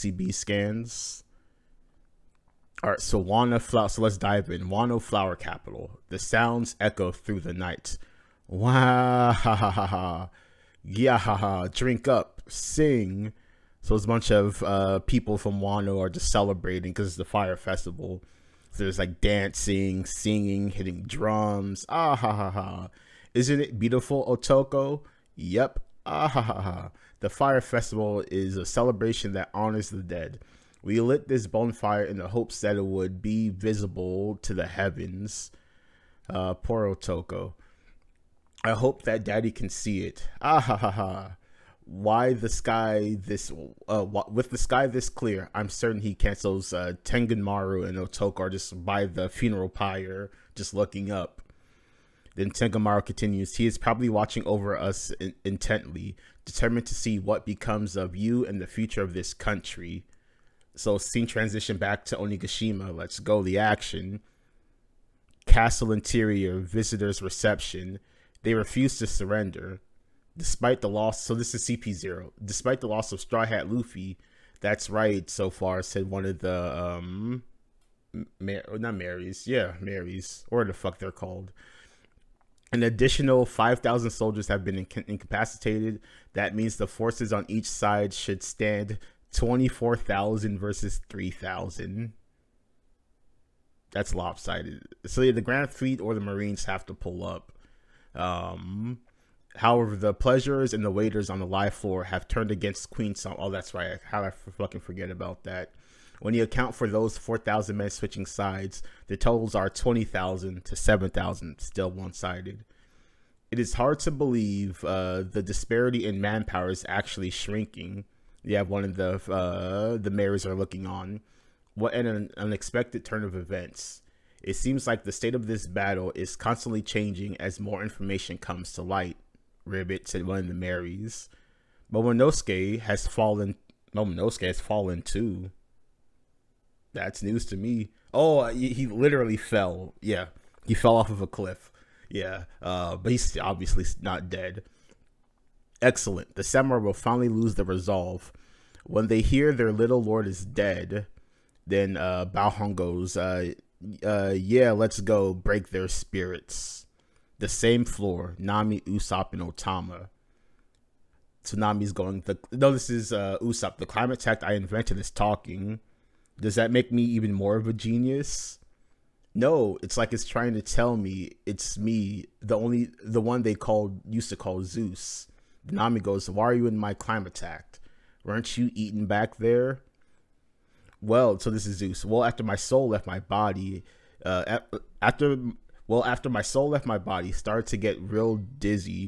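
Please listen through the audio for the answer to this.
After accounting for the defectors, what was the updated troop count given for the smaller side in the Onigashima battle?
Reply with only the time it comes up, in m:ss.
1:50.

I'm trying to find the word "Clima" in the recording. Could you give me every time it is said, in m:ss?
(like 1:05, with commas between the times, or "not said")
2:43, 2:56.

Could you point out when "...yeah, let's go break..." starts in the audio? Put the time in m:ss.
2:34.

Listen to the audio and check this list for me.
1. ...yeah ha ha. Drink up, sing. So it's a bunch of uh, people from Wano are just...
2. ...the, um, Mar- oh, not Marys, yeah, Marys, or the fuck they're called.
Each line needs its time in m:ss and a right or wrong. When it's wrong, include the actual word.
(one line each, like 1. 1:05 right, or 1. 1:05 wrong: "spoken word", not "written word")
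1. 0:10 right
2. 1:16 right.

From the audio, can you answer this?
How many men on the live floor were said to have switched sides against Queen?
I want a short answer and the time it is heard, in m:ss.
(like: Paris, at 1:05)
4,000, at 1:47.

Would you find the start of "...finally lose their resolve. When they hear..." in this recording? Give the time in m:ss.
2:26.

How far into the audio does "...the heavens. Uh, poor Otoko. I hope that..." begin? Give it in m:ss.
0:34.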